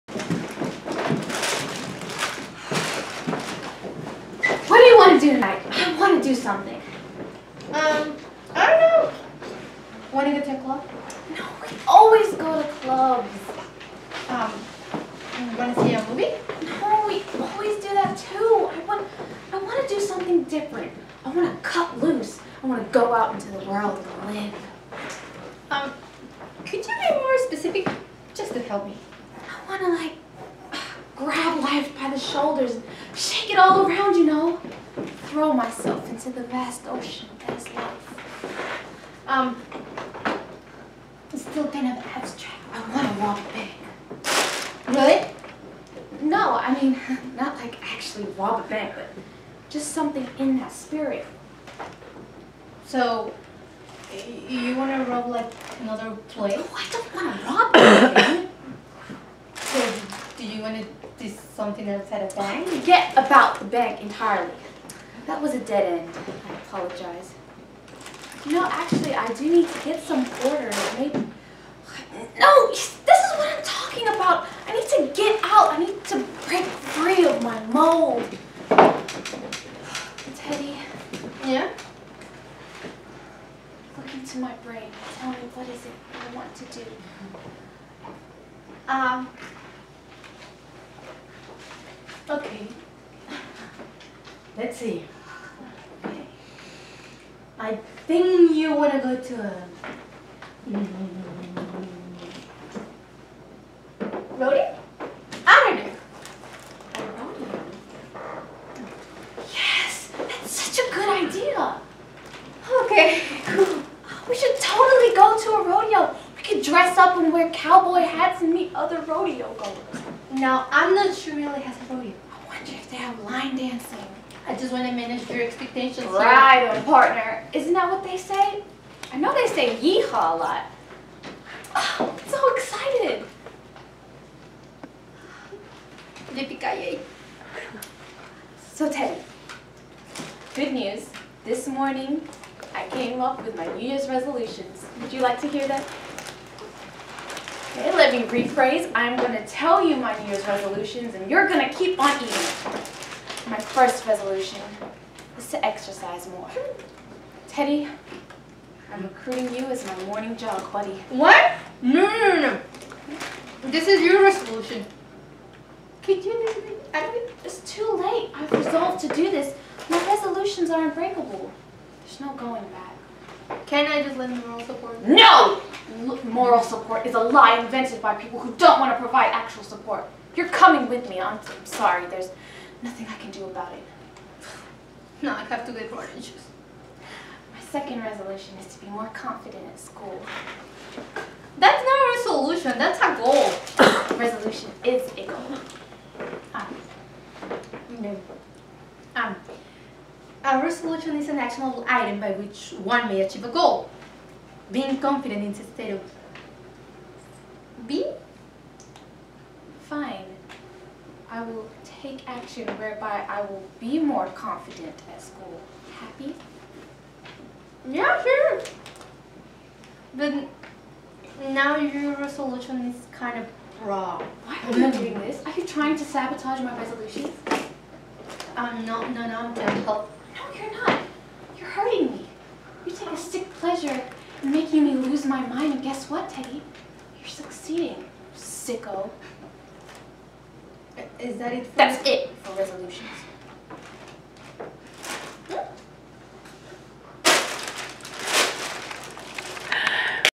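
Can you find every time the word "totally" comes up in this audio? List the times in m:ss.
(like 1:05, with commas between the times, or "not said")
1:54.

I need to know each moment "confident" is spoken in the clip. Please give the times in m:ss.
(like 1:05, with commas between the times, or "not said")
3:09, 3:24, 3:34.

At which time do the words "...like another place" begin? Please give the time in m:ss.
0:55.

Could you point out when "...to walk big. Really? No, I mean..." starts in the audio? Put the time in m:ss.
0:43.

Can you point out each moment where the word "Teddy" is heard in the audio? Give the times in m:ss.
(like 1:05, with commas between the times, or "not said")
1:20, 2:18, 2:37, 3:56.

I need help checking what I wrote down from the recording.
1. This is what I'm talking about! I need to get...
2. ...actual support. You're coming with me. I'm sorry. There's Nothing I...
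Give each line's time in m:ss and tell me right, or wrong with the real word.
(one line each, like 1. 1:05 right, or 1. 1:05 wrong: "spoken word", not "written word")
1. 1:12 right
2. 2:59 right.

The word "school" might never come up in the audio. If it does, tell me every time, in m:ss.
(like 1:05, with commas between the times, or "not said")
3:09, 3:35.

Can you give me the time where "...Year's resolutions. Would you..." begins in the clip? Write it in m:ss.
2:23.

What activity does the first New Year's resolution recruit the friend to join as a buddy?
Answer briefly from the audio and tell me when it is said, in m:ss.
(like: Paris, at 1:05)
Morning jog, at 2:40.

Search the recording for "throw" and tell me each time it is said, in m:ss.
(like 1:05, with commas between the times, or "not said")
0:35.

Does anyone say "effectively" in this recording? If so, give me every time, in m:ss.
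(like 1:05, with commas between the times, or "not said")
not said.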